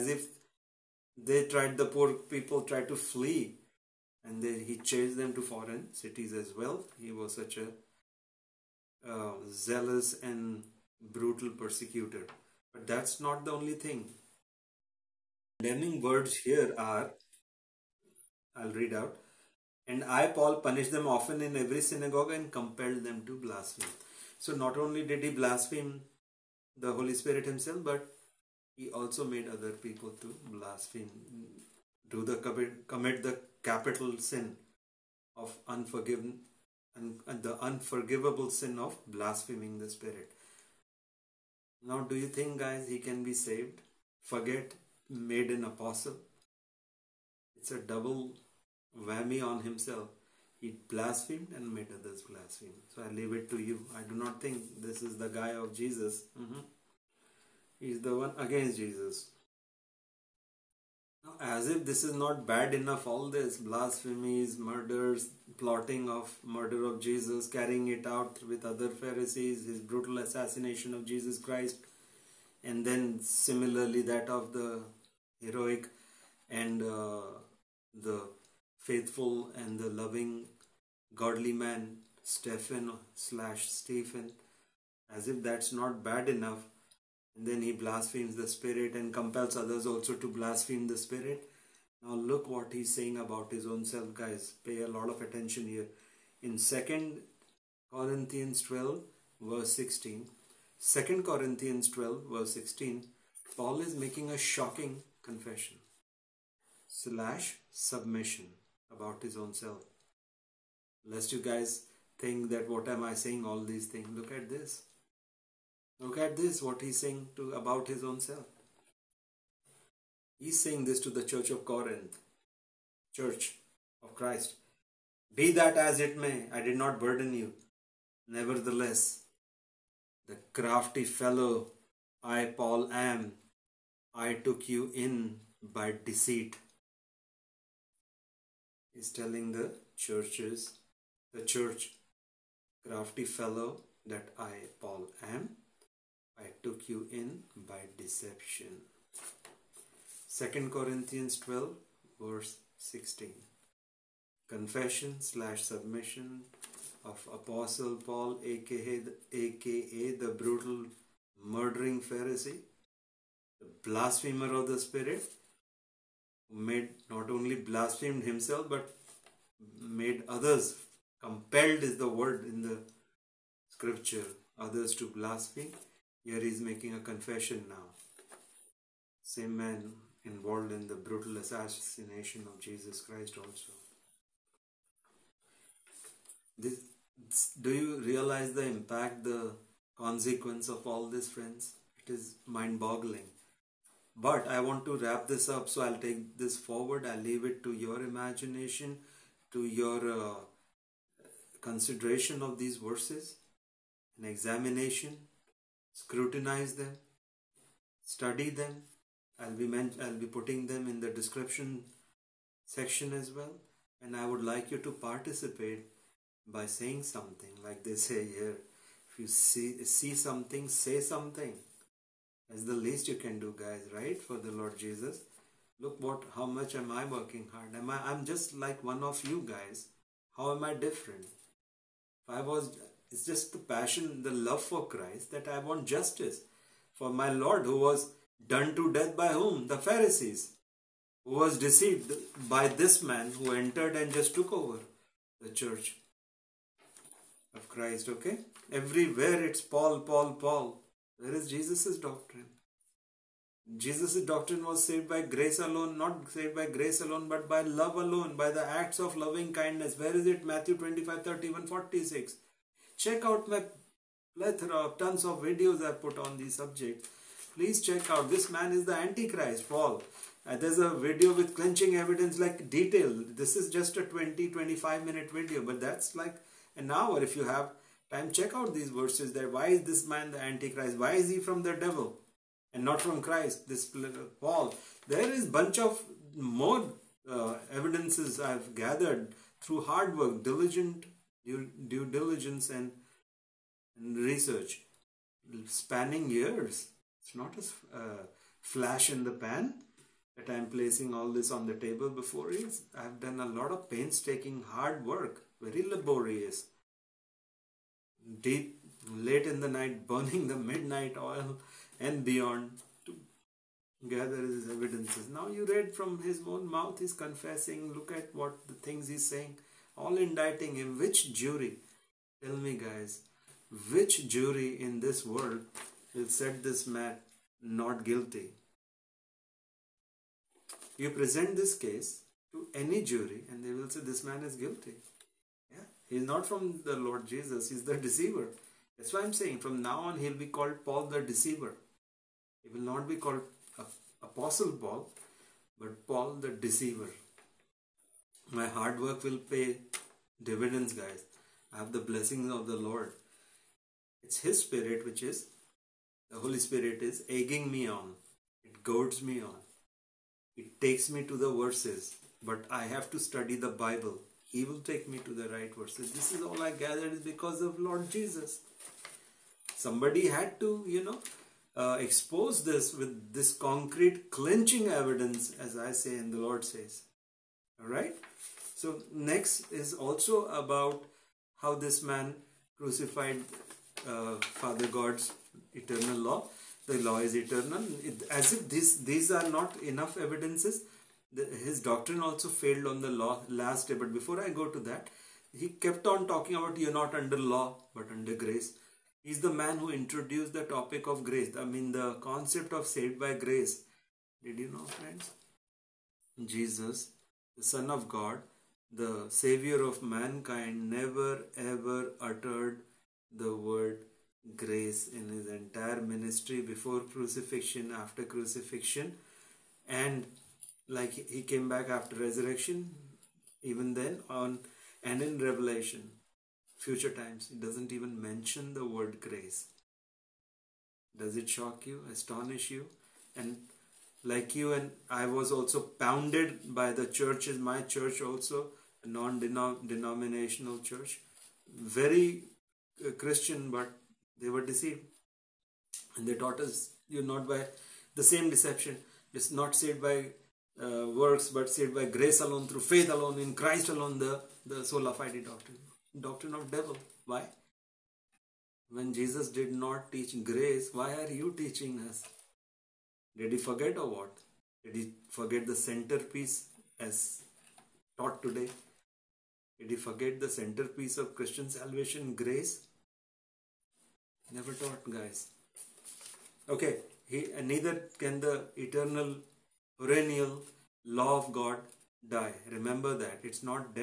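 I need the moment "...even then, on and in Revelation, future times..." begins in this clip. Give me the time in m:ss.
7:03.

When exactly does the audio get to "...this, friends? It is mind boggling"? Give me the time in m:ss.
3:11.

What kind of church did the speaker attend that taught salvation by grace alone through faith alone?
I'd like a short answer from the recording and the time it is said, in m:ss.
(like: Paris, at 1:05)
non-denominational church, at 7:19.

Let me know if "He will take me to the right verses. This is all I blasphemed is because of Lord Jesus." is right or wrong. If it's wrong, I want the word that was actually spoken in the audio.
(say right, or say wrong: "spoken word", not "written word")
wrong: "gathered", not "blasphemed".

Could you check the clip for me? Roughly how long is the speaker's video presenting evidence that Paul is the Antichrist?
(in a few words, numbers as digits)
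an hour.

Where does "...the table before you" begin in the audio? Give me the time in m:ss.
5:01.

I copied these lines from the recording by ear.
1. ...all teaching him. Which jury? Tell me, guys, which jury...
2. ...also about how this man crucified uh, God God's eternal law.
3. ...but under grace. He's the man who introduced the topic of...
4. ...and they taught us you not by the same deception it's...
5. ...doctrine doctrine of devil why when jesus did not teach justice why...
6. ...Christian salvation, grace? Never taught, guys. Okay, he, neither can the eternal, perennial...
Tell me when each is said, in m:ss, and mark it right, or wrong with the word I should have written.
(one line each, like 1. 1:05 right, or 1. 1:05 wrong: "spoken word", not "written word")
1. 5:19 wrong: "indicting", not "teaching"
2. 6:19 wrong: "Father", not "God"
3. 6:37 right
4. 7:26 right
5. 7:35 wrong: "grace", not "justice"
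6. 7:51 right.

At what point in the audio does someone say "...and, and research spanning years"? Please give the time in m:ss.
4:52.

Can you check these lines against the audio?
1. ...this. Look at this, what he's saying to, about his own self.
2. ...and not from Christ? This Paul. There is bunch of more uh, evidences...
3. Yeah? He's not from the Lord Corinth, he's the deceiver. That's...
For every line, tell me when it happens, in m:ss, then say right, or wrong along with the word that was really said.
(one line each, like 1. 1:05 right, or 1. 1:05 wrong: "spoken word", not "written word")
1. 1:54 right
2. 4:42 right
3. 5:35 wrong: "Jesus", not "Corinth".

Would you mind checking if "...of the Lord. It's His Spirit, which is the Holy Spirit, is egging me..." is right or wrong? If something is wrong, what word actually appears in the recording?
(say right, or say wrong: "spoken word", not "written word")
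right.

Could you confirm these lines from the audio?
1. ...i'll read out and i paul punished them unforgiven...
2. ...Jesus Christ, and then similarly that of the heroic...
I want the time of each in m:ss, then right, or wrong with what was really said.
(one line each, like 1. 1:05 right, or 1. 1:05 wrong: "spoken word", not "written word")
1. 0:18 wrong: "often", not "unforgiven"
2. 1:11 right.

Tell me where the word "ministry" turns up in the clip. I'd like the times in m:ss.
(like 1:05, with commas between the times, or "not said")
6:56.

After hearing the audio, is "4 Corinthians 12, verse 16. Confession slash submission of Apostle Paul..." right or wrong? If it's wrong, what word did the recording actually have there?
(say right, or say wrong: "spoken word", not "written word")
wrong: "2", not "4".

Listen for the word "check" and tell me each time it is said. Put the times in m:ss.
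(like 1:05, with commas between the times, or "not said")
4:23, 4:27, 4:38.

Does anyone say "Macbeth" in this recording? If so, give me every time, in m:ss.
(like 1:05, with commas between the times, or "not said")
not said.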